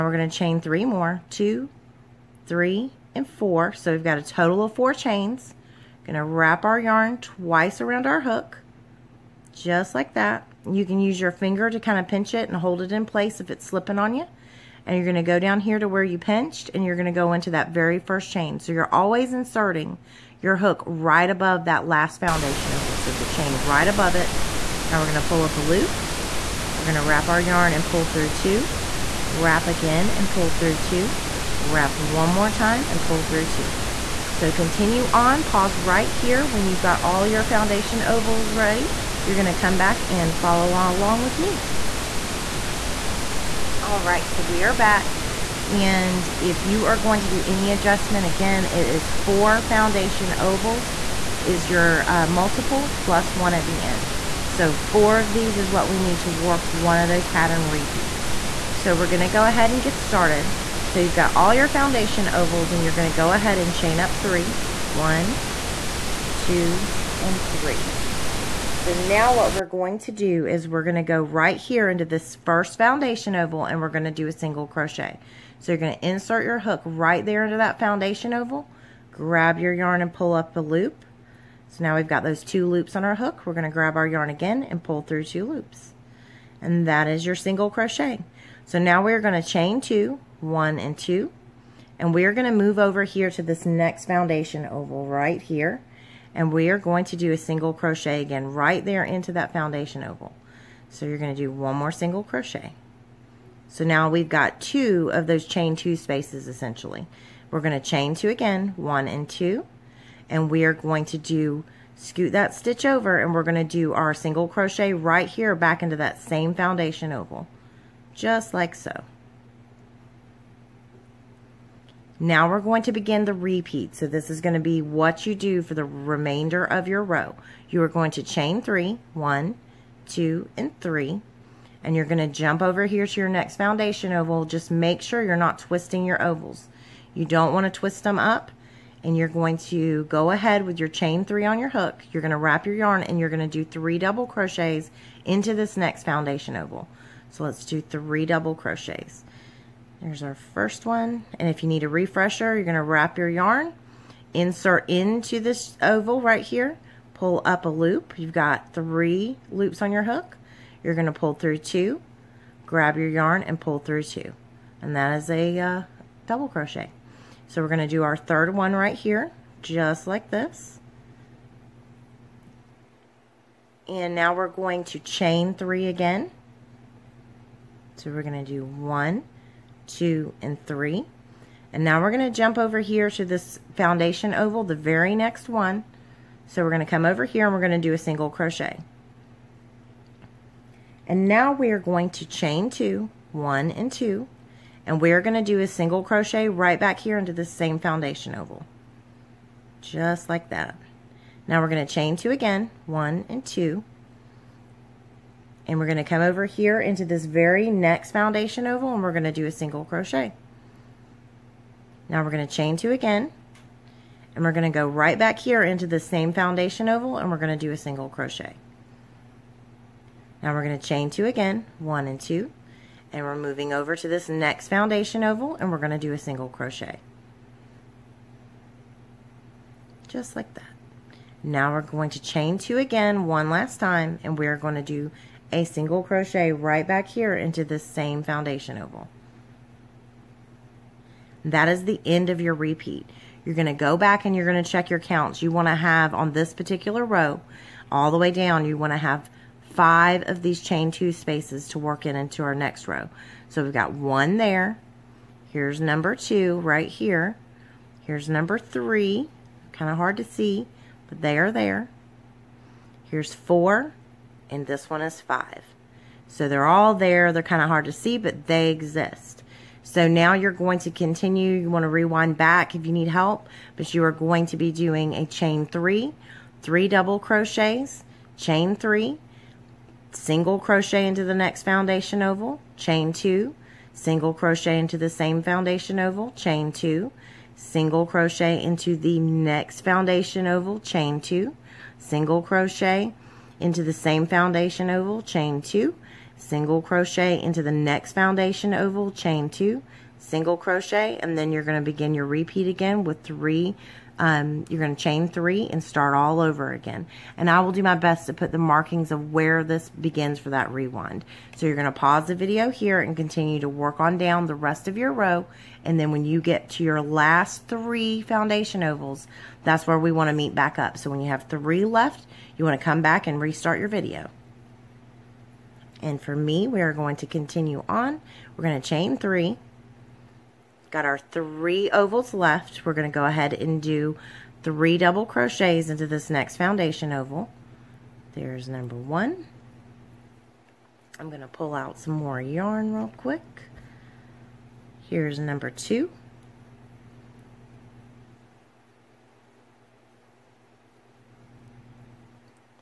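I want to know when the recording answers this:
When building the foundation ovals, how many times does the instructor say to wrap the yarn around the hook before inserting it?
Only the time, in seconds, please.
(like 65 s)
7 s.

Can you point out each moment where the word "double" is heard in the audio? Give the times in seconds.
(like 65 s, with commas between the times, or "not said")
143 s, 148 s, 166 s, 276 s, 334 s.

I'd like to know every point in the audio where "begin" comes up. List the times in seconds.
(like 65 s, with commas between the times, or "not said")
122 s, 301 s, 309 s.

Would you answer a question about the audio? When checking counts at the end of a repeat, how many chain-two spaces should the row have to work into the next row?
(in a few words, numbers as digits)
5.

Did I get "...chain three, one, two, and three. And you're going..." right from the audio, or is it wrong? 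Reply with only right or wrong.
right.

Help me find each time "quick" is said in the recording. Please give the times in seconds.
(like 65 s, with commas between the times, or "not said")
343 s.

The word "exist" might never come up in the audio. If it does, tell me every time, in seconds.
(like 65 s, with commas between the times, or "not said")
268 s.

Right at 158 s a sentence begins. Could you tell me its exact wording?
You've got three loops on your hook.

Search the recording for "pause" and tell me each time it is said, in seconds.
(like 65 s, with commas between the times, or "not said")
35 s, 311 s.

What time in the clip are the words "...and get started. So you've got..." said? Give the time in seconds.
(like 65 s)
59 s.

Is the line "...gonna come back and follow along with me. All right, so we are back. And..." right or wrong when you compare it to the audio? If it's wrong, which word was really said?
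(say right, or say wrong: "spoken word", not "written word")
right.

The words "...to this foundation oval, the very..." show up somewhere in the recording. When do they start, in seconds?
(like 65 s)
183 s.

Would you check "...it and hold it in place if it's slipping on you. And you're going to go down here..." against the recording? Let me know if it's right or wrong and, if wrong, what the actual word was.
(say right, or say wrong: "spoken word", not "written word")
right.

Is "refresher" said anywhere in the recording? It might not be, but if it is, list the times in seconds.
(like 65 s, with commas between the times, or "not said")
151 s.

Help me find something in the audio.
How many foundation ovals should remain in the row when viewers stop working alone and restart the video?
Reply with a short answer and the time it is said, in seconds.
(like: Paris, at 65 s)
3 left, at 321 s.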